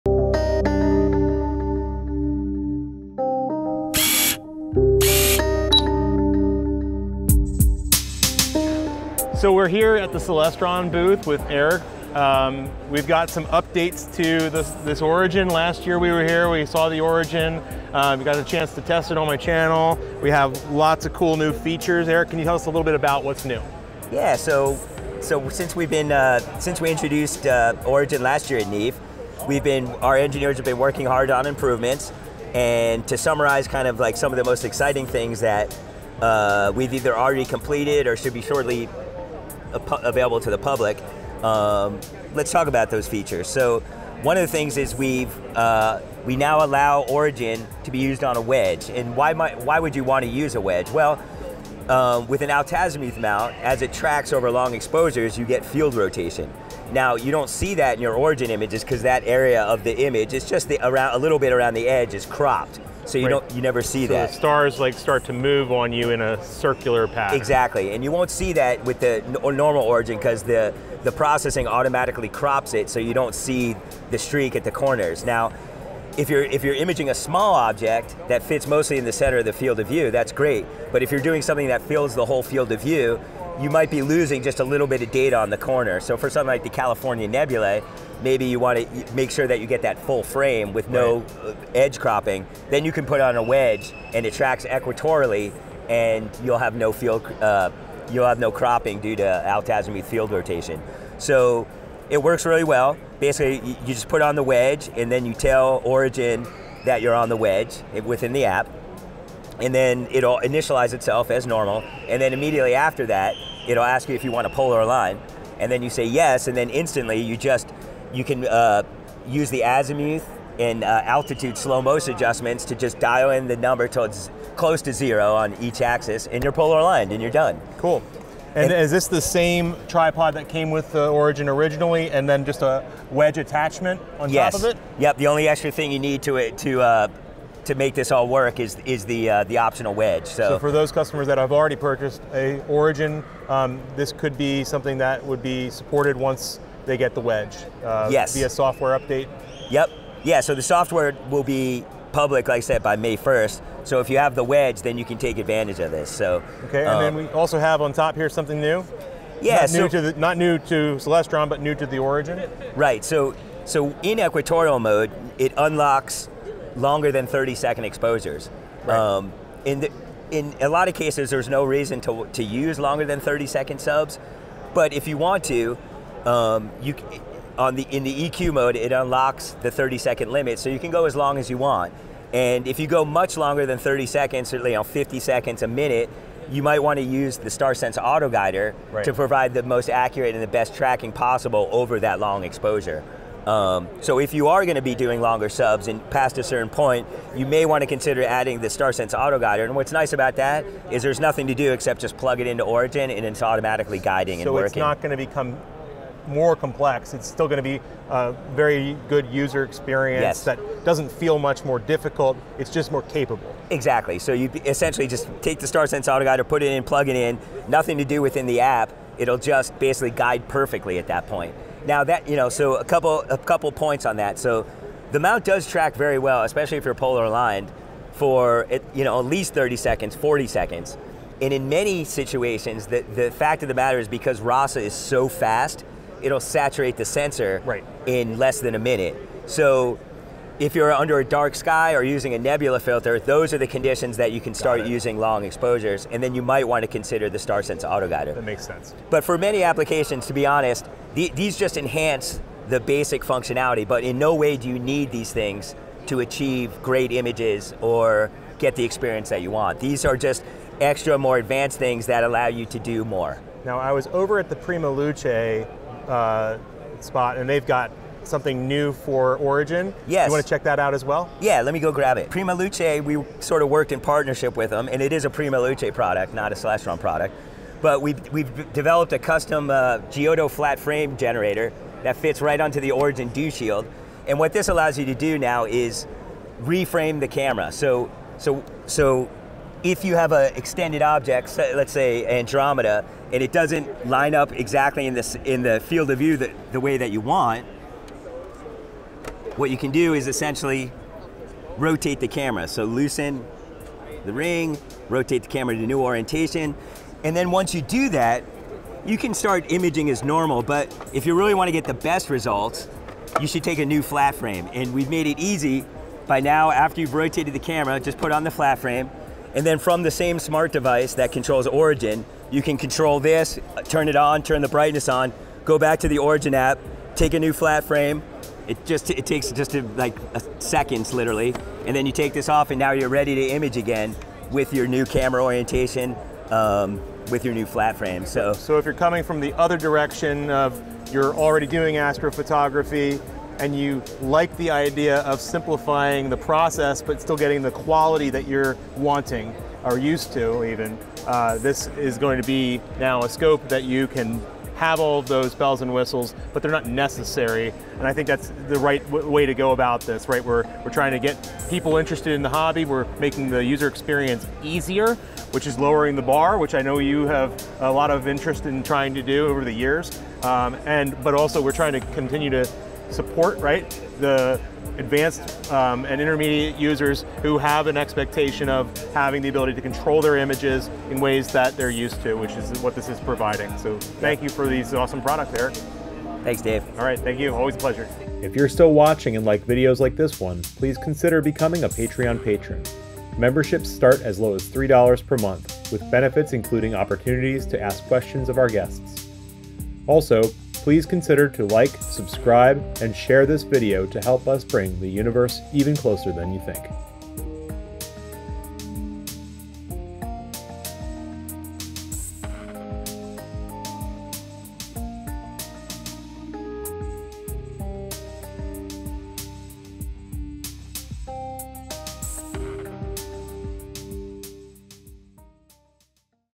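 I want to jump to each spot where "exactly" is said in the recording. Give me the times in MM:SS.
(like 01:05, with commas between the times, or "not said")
01:07, 03:33, 04:54.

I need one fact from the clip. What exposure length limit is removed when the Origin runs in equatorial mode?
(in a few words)
30 seconds.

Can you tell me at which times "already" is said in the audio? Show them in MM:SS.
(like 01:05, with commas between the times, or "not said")
00:37, 02:21, 05:41.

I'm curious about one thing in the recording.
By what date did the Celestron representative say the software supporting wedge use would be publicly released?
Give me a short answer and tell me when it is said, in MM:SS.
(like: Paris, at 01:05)
May 1st, at 02:32.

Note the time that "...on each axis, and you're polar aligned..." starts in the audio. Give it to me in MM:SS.
02:05.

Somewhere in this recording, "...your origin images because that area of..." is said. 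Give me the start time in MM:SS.
00:58.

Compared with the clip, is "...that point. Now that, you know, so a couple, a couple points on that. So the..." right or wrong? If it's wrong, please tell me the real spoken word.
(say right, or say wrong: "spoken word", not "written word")
right.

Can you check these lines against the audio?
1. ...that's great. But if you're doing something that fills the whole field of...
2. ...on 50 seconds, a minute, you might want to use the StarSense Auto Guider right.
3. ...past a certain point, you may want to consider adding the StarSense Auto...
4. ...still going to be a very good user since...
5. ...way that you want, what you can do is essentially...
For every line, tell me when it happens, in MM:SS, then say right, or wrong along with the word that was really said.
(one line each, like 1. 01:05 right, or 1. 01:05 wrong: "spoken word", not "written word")
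1. 01:20 right
2. 03:04 right
3. 03:16 right
4. 03:27 wrong: "experience", not "since"
5. 04:56 right.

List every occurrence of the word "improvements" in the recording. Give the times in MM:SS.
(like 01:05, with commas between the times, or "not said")
00:31.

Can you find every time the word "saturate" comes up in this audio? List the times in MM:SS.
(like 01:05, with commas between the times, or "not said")
03:56.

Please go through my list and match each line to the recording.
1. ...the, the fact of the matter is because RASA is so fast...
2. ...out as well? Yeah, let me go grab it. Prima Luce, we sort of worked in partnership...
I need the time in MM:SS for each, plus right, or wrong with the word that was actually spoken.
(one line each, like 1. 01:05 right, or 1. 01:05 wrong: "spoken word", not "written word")
1. 03:52 right
2. 04:30 right.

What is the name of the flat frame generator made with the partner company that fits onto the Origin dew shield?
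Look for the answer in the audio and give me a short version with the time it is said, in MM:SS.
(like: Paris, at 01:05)
Giotto, at 04:40.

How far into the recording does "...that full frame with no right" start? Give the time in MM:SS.
01:29.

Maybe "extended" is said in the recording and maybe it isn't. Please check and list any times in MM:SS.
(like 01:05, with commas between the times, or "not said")
04:50.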